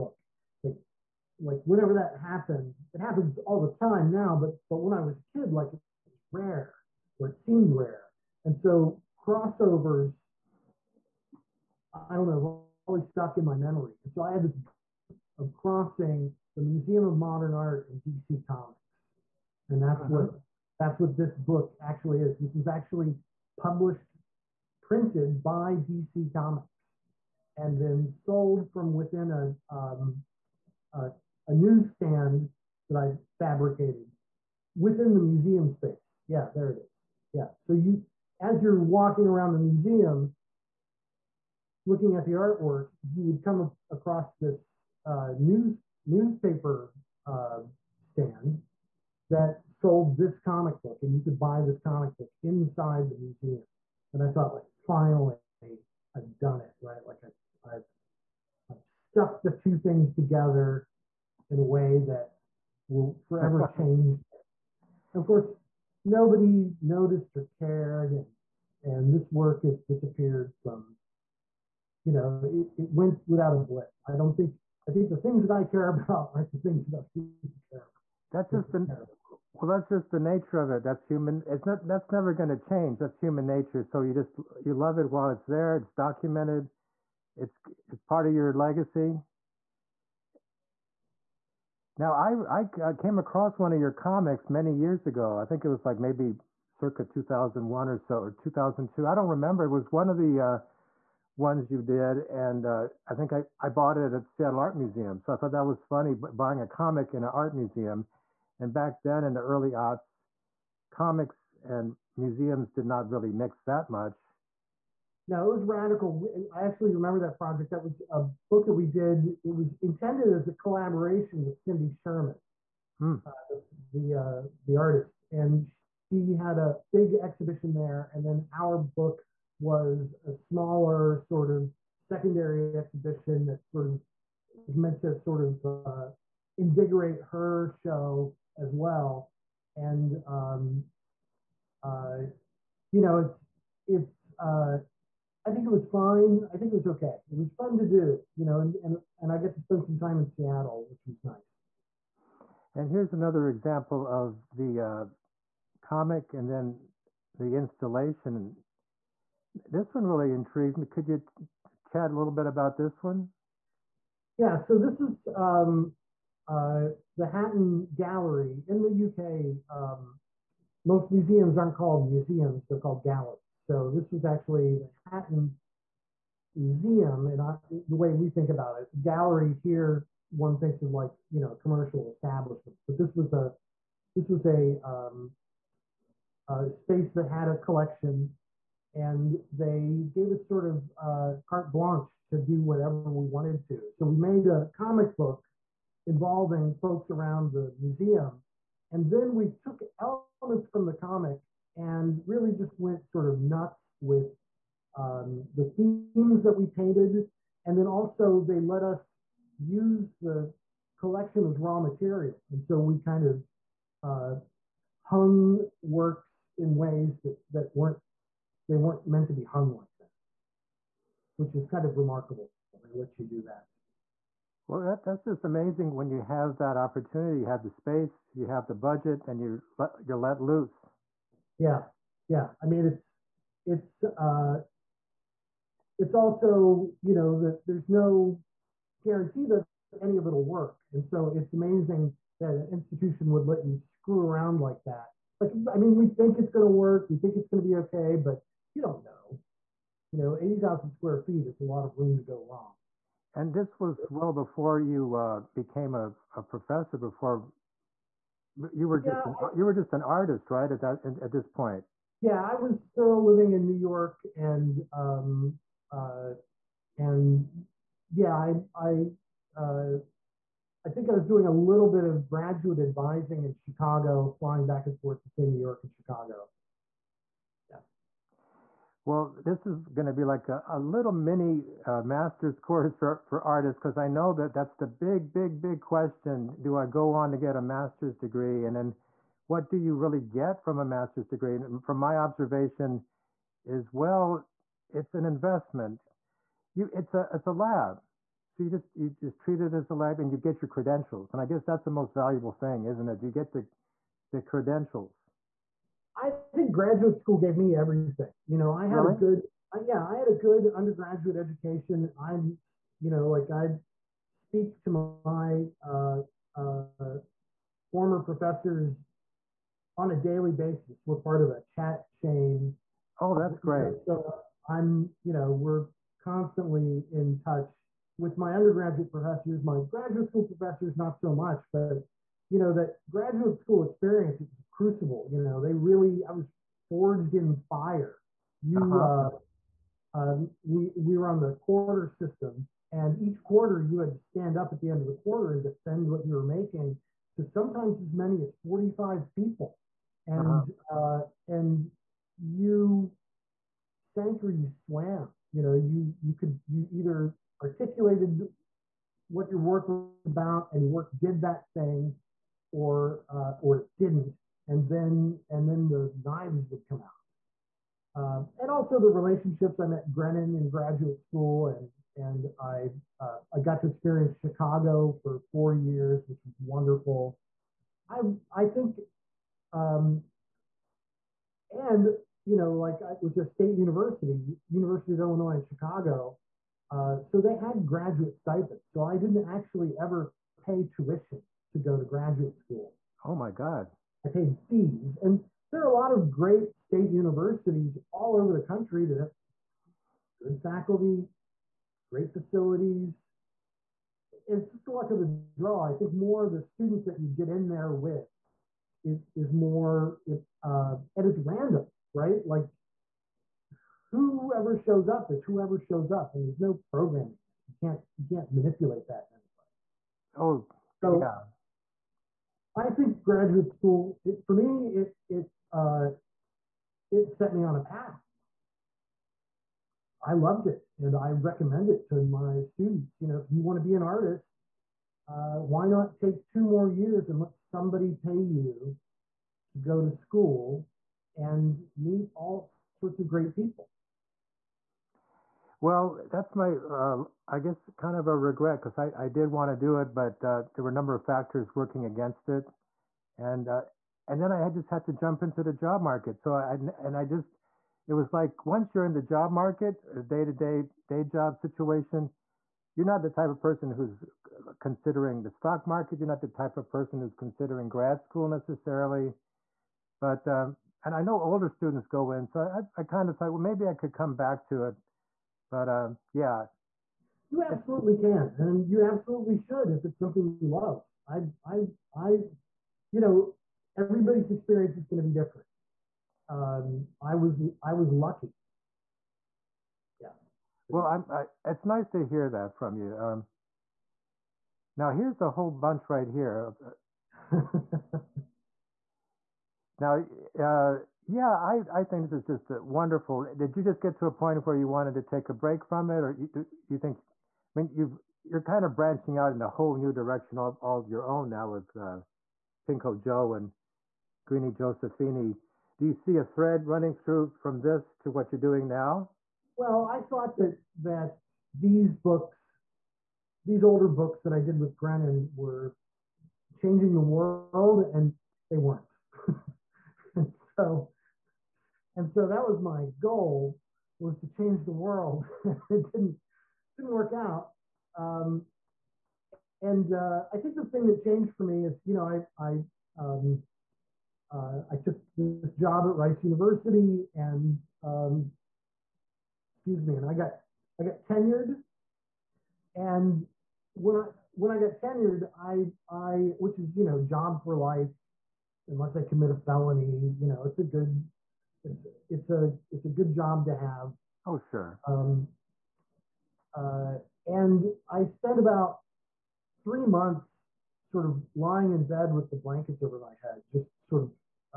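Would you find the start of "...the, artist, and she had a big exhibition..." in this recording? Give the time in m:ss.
2:04.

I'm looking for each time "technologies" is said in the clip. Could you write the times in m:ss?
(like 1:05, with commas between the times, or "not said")
not said.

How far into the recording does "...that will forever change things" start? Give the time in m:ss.
1:02.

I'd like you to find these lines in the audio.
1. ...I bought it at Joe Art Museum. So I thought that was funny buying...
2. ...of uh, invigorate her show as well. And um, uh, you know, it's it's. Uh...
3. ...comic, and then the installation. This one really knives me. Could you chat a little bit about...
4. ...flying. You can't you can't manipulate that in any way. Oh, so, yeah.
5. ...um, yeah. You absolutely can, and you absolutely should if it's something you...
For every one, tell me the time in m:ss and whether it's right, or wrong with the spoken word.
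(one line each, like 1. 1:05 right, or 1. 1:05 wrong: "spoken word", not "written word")
1. 1:43 wrong: "Seattle", not "Joe"
2. 2:15 right
3. 2:35 wrong: "intrigues", not "knives"
4. 6:56 wrong: "programming", not "flying"
5. 7:55 right.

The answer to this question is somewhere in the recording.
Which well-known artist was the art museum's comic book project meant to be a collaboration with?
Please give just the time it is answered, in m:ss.
2:01.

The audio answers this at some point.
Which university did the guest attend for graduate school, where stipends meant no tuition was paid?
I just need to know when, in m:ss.
6:24.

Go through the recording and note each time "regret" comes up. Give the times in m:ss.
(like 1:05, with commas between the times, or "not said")
7:28.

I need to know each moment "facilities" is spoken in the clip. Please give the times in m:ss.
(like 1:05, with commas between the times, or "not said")
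6:42.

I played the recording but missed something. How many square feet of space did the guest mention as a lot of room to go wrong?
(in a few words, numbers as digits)
80,000.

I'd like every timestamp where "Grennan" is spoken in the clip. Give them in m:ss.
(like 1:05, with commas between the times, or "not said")
6:10, 8:44.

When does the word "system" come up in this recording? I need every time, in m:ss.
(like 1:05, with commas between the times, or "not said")
5:42.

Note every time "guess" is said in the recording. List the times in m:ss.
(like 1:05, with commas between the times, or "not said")
5:01, 7:27.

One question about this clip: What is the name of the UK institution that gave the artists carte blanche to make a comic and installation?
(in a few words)
Hatton Gallery.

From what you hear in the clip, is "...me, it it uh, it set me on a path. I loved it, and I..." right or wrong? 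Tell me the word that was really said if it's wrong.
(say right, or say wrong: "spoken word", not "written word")
right.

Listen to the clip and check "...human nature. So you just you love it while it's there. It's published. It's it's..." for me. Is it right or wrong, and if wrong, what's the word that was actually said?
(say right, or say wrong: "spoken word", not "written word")
wrong: "documented", not "published".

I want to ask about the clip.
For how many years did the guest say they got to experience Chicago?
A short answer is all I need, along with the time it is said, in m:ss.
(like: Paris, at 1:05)
4, at 6:15.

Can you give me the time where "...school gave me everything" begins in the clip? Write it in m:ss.
5:07.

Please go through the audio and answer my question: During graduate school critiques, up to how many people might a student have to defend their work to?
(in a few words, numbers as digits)
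45.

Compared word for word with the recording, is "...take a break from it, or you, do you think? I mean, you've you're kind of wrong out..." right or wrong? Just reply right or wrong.
wrong.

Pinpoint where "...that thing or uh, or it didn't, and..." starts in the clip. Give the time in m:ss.
6:01.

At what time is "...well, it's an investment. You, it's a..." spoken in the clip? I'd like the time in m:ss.
4:53.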